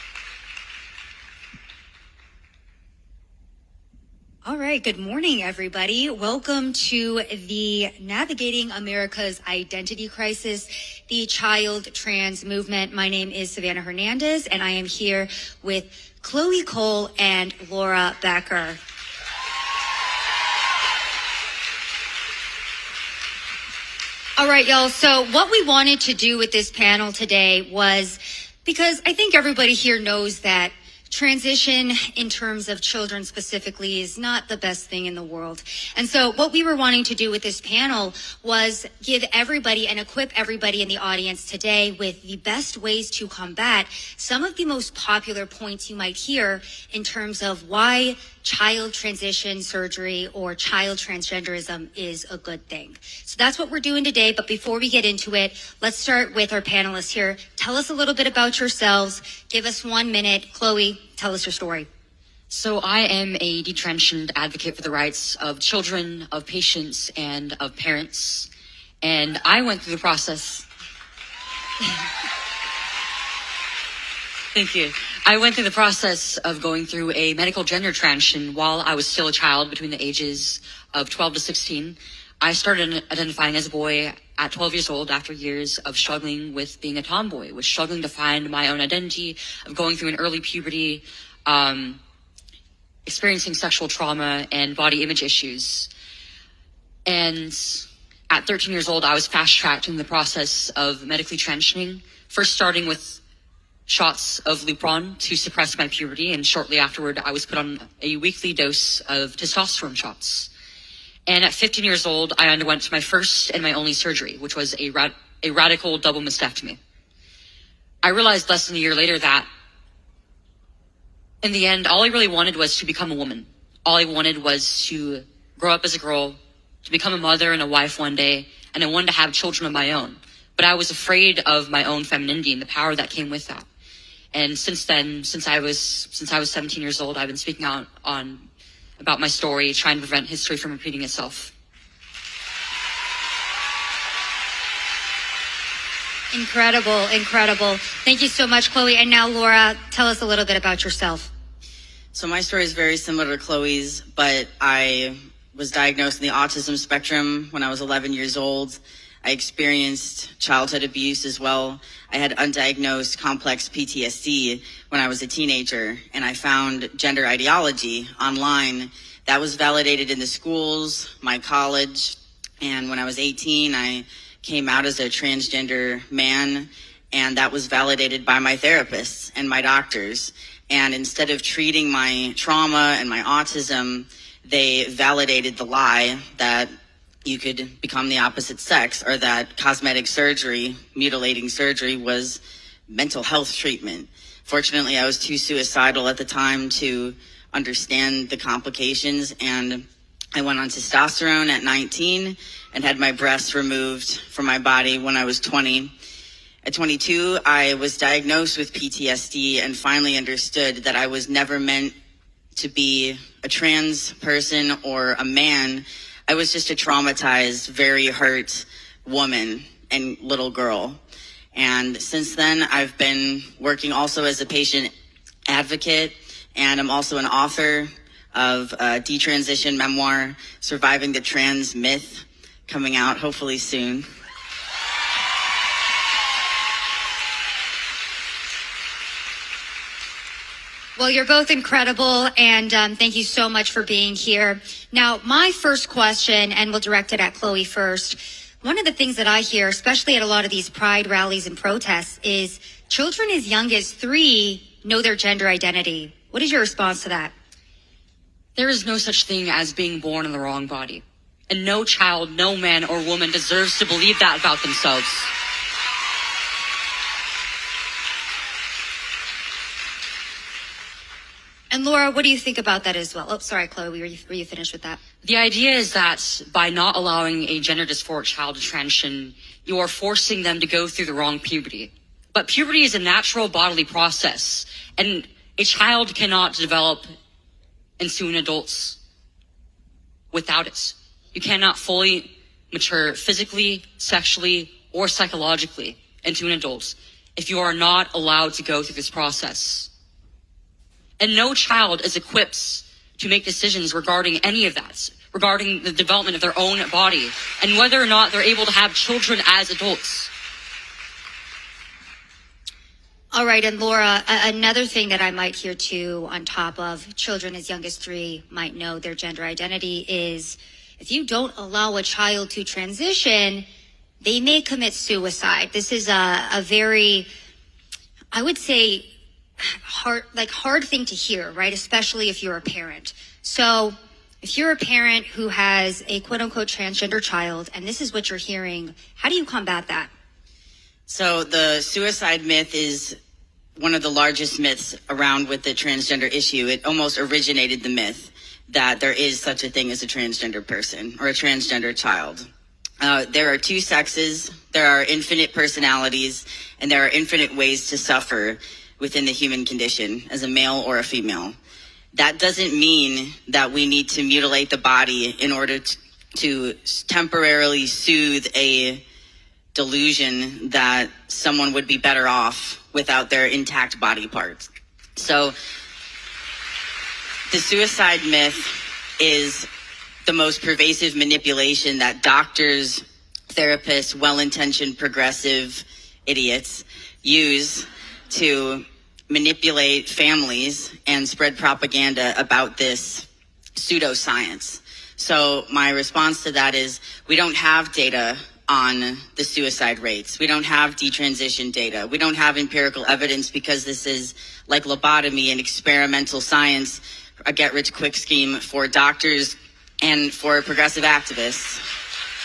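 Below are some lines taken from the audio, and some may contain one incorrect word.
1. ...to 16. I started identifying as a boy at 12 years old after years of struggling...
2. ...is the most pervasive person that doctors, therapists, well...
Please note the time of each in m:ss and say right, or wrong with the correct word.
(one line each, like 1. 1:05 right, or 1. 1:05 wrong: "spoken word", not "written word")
1. 1:21 right
2. 6:19 wrong: "manipulation", not "person".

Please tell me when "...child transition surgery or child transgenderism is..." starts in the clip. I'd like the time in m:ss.
0:48.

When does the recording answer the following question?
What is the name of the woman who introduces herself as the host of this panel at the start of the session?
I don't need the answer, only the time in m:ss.
0:13.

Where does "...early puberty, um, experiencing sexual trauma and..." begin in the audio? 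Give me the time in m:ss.
1:30.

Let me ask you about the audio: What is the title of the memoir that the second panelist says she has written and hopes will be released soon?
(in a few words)
Surviving the Trans Myth.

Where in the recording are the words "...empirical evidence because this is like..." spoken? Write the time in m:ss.
6:42.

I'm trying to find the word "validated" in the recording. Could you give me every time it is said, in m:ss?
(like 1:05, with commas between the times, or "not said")
2:49, 2:57, 3:04.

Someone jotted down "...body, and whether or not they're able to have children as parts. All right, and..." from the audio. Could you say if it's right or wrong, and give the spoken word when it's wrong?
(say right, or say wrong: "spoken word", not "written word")
wrong: "adults", not "parts".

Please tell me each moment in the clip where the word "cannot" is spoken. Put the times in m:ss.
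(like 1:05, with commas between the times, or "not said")
4:46, 4:51.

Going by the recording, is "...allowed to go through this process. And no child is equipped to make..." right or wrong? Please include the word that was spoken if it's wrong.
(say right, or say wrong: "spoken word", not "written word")
right.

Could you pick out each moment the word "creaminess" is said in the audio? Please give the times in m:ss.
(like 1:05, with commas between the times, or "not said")
not said.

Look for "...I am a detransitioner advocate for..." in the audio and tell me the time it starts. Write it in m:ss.
1:02.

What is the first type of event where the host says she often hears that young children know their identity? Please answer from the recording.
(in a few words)
Pride rallies.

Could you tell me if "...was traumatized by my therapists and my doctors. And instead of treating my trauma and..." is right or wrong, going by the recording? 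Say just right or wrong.
wrong.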